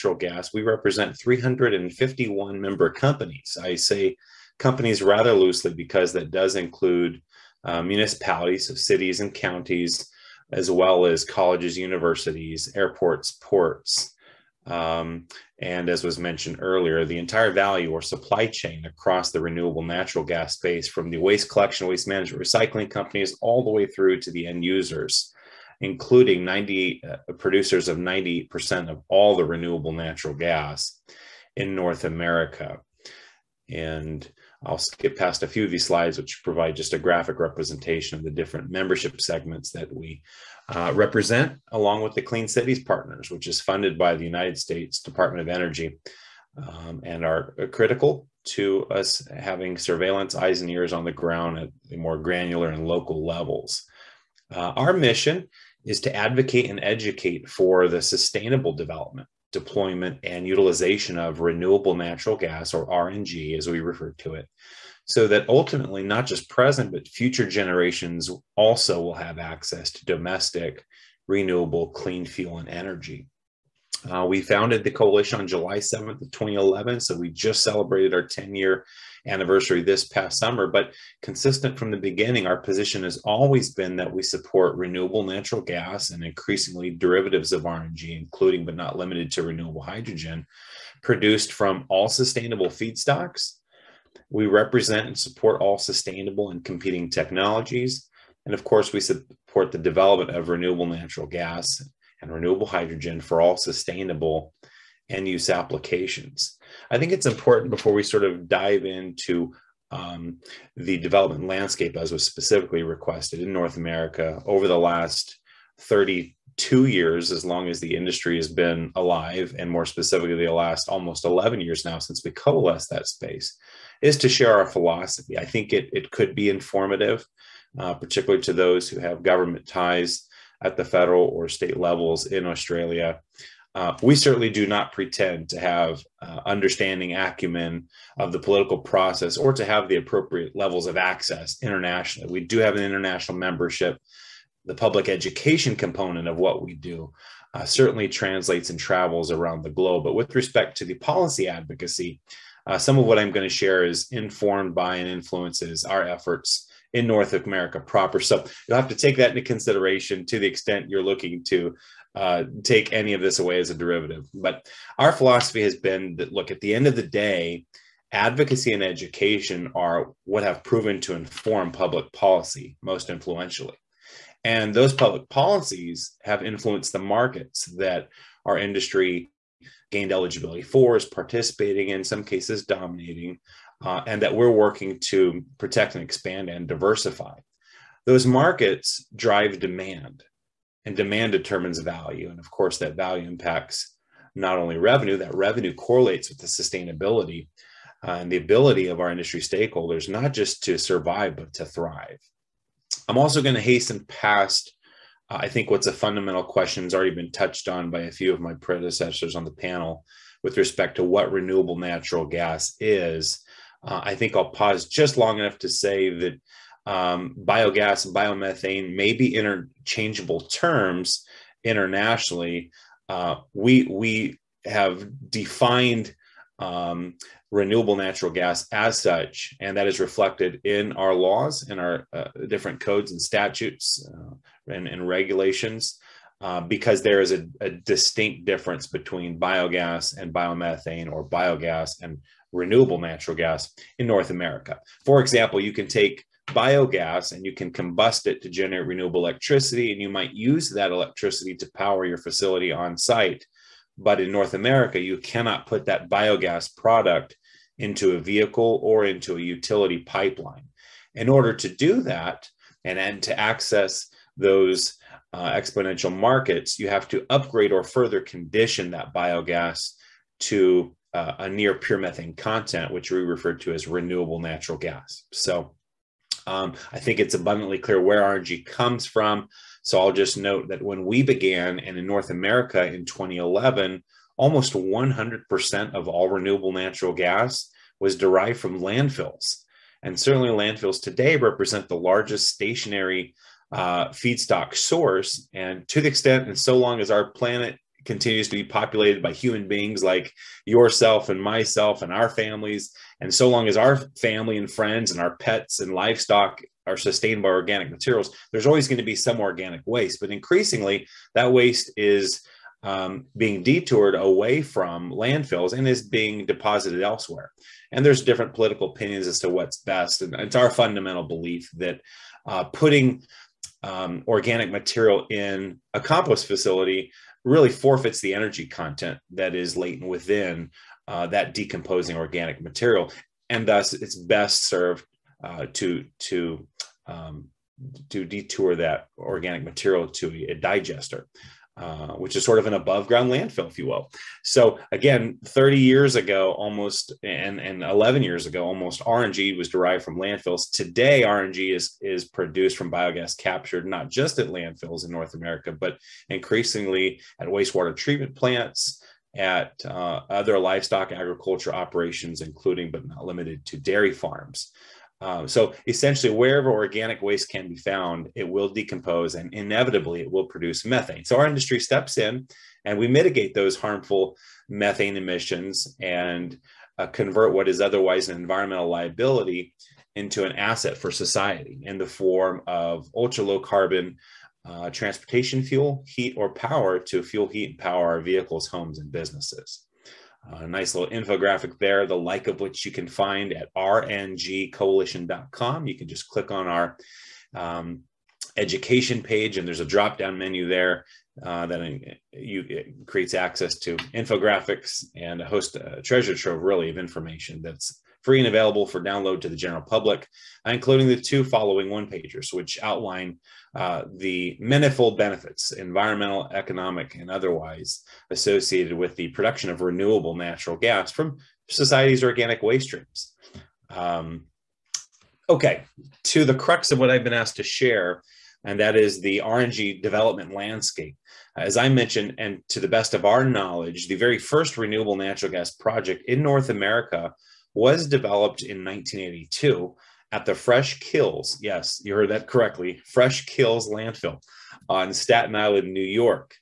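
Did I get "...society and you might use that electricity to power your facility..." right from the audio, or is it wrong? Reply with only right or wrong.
wrong.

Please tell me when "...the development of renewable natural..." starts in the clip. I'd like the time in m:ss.
1:39.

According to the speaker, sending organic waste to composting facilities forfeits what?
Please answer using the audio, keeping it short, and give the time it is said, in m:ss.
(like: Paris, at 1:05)
the energy content, at 5:28.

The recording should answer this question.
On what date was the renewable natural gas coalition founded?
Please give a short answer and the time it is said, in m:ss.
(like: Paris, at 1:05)
July 7, 2011, at 1:15.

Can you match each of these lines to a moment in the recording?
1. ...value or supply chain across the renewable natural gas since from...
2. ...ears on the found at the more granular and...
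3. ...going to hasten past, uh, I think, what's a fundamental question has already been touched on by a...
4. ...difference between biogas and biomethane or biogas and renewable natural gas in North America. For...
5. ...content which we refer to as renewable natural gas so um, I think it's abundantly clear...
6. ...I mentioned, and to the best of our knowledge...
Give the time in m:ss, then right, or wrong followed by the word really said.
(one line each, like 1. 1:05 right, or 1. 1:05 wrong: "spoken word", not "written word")
1. 0:17 wrong: "space", not "since"
2. 0:50 wrong: "ground", not "found"
3. 3:23 right
4. 3:58 right
5. 4:32 right
6. 7:11 right.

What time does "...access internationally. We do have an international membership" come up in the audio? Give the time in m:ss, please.
2:20.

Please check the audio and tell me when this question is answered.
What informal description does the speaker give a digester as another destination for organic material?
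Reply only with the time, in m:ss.
5:42.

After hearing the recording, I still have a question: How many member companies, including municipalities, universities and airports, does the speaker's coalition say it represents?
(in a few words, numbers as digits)
351.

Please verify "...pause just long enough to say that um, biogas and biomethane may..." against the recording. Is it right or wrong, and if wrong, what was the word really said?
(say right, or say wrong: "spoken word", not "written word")
right.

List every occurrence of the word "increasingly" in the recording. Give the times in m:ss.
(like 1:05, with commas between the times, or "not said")
1:26, 5:10, 5:56.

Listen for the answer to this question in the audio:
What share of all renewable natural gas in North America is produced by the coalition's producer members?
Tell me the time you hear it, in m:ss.
0:27.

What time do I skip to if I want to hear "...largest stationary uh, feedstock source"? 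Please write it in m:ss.
4:51.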